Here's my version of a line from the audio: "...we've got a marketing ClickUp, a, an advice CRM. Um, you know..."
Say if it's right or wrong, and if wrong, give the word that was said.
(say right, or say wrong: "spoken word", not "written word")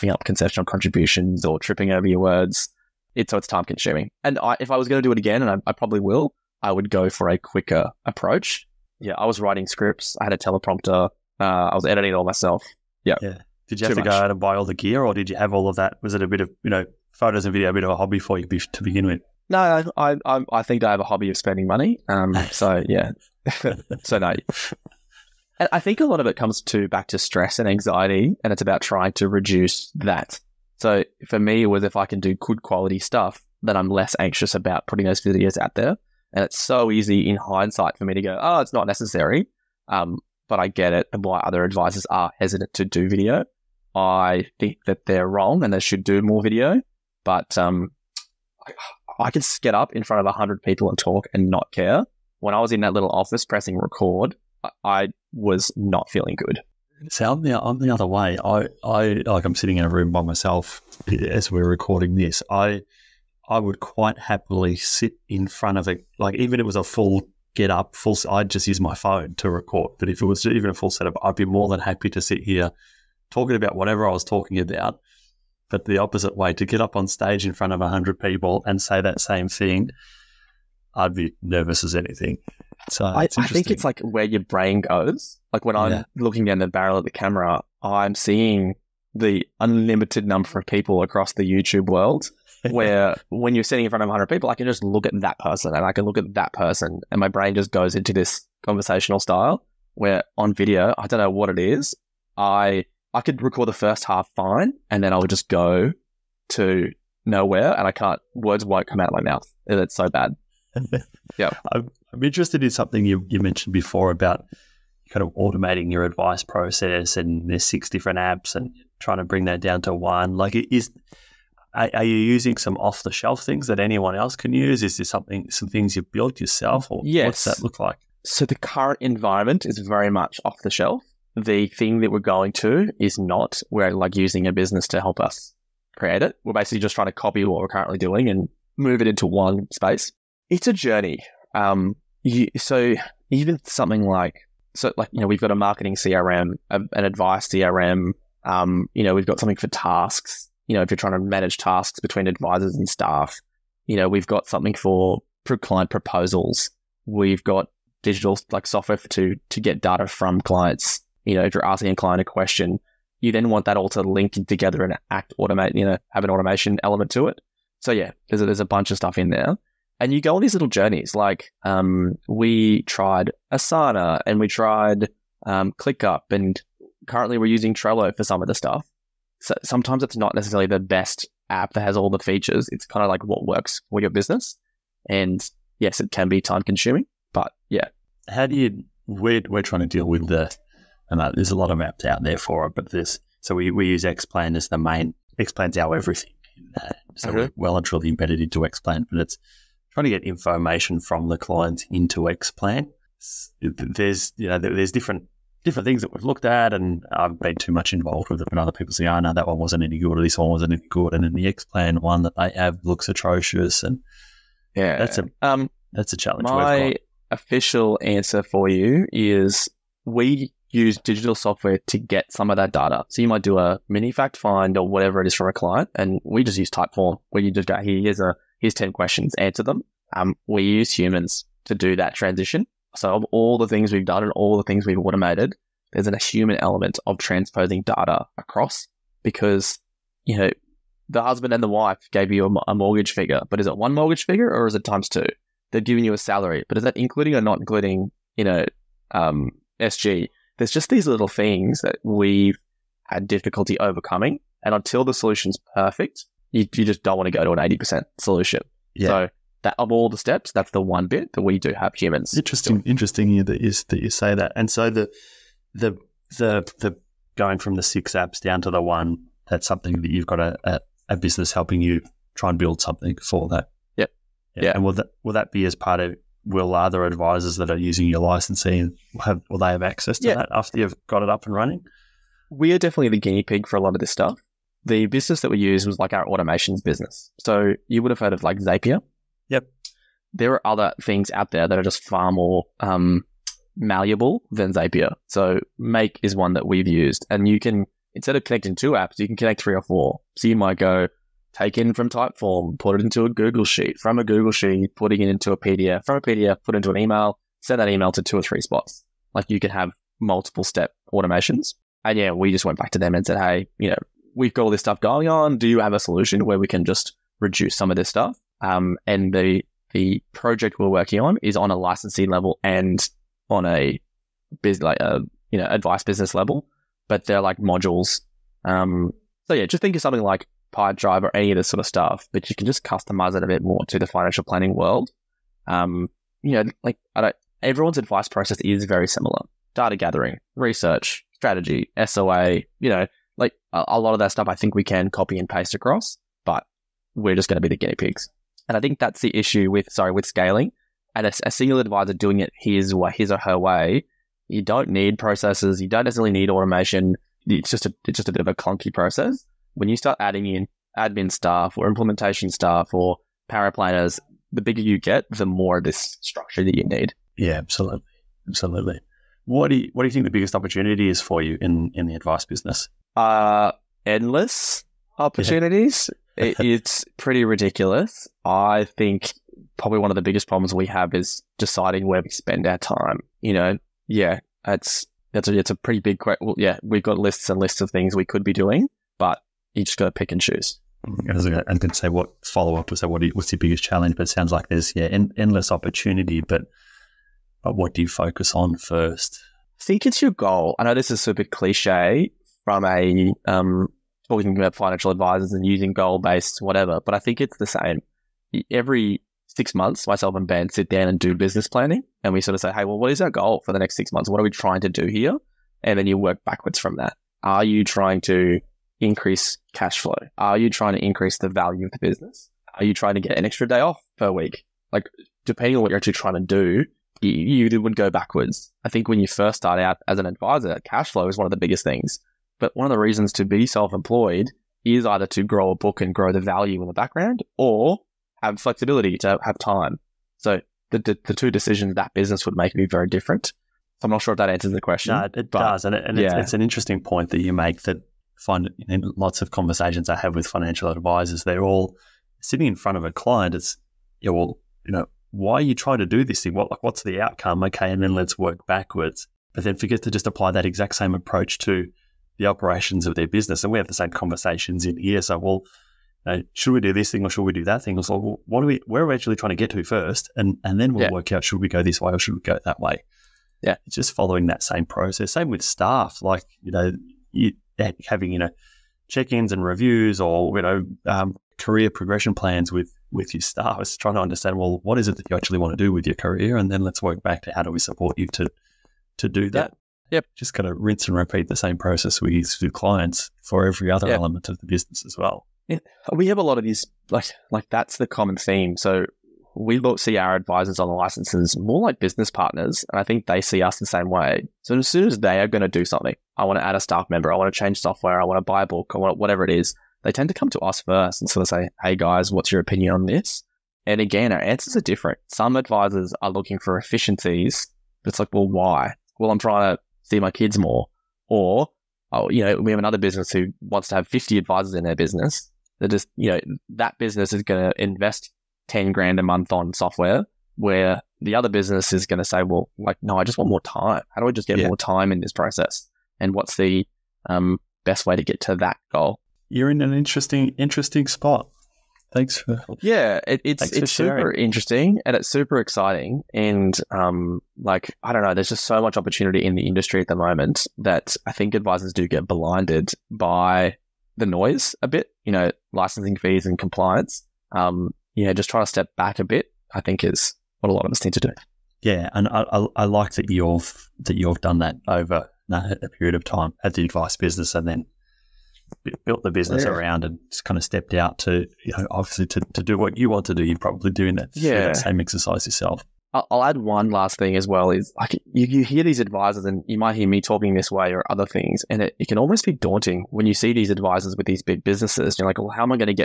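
wrong: "CRM", not "ClickUp".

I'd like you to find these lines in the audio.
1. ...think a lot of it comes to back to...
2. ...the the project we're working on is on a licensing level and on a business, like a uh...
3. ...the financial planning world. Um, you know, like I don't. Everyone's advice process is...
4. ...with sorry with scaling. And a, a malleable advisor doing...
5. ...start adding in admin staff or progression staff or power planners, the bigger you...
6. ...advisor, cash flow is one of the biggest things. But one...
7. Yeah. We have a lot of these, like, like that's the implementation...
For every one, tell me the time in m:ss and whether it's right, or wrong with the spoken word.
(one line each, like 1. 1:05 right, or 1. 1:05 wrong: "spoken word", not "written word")
1. 0:25 right
2. 5:19 right
3. 5:33 right
4. 5:49 wrong: "single", not "malleable"
5. 5:59 wrong: "implementation", not "progression"
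6. 7:10 right
7. 8:15 wrong: "common", not "implementation".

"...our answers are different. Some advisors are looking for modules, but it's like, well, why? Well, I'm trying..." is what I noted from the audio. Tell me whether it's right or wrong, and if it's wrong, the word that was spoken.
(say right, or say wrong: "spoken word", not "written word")
wrong: "efficiencies", not "modules".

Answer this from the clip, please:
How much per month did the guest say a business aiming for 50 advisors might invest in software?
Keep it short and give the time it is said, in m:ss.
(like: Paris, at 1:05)
10 grand, at 8:48.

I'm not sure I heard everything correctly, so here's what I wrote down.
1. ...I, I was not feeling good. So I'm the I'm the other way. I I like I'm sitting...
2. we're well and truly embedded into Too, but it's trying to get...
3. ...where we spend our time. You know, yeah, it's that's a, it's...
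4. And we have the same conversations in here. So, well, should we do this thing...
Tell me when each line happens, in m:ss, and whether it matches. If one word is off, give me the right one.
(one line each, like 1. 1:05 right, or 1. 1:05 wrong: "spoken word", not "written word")
1. 0:54 right
2. 3:17 wrong: "Xplan", not "Too"
3. 6:22 right
4. 7:43 right.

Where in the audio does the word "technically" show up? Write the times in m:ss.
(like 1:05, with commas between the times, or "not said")
not said.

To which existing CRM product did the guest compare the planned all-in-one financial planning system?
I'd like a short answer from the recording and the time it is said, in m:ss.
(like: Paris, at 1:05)
Pipedrive, at 5:30.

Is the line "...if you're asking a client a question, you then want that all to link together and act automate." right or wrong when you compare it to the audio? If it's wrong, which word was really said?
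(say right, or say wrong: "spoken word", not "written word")
right.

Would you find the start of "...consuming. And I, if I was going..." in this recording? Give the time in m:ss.
0:03.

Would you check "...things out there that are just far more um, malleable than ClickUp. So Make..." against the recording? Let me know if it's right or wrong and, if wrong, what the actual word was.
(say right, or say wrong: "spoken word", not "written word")
wrong: "Zapier", not "ClickUp".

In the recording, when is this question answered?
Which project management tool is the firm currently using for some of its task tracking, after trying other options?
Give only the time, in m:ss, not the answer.
2:57.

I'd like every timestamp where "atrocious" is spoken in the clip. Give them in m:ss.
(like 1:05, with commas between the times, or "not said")
3:33.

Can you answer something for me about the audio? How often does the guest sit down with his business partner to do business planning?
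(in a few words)
every 6 months.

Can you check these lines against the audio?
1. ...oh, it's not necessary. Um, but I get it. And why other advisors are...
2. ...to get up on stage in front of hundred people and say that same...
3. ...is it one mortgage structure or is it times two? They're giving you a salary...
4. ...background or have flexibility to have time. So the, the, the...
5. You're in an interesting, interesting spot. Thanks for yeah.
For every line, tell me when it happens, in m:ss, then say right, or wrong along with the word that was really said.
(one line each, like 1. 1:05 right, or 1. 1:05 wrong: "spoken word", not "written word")
1. 0:38 right
2. 1:16 right
3. 4:03 wrong: "figure", not "structure"
4. 7:16 right
5. 8:59 right.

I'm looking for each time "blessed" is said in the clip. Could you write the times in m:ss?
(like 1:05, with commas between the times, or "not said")
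not said.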